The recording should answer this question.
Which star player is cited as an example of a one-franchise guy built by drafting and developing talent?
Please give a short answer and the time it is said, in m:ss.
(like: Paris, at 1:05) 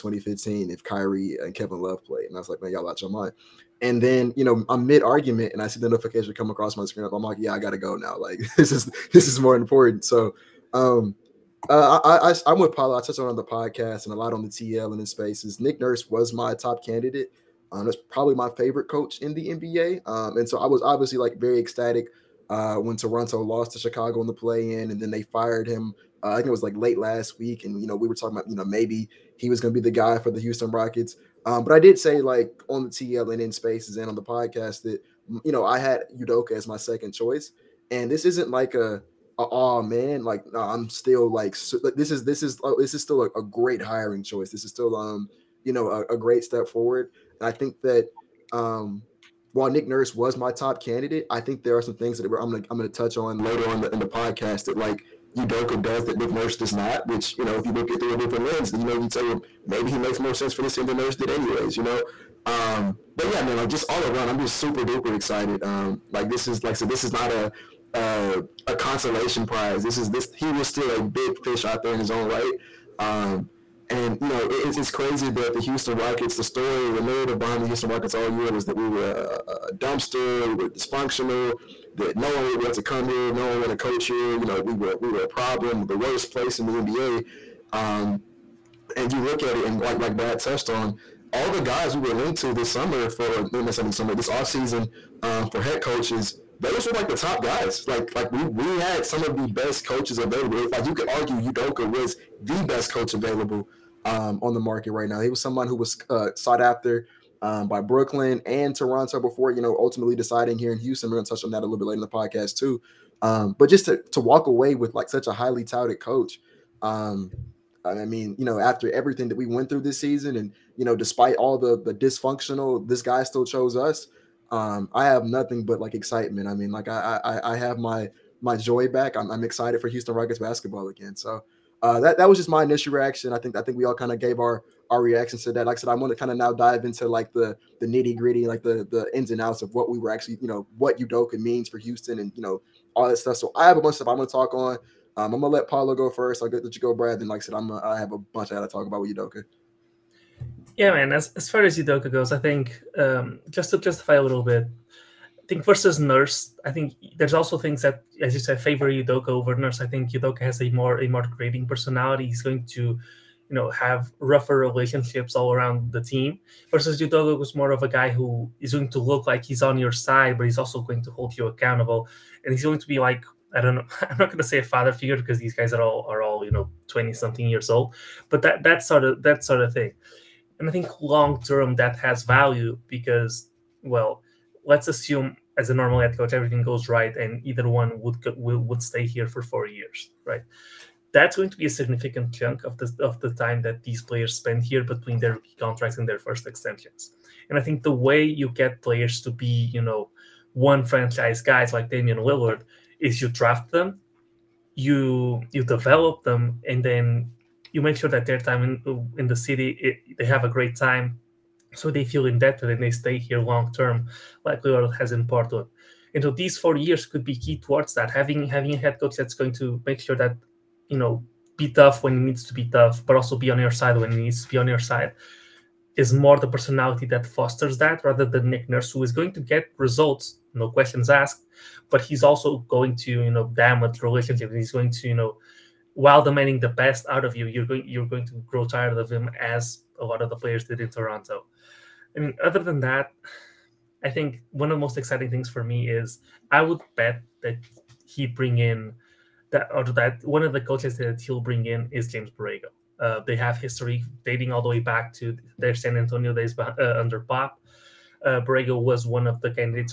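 Damian Lillard, at 3:21.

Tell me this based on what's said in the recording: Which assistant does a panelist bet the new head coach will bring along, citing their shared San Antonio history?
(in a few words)
James Borrego.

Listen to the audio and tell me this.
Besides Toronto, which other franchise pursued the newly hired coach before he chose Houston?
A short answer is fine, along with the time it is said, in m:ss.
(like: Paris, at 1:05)
Brooklyn, at 1:47.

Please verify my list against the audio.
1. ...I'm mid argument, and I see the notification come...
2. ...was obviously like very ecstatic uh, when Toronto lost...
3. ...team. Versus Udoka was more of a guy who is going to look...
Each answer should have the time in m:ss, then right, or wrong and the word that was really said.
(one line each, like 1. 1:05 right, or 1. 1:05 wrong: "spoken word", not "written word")
1. 0:04 right
2. 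0:20 right
3. 2:46 right.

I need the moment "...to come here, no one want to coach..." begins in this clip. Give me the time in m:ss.
1:22.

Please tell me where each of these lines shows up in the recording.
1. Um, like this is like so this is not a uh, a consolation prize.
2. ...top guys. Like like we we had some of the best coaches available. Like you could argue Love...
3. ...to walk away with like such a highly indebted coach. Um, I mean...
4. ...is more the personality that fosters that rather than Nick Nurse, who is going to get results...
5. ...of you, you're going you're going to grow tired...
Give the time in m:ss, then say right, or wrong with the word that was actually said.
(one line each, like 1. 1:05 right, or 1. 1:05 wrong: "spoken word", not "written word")
1. 1:05 right
2. 1:37 wrong: "Udoka", not "Love"
3. 1:54 wrong: "touted", not "indebted"
4. 3:45 right
5. 3:57 right.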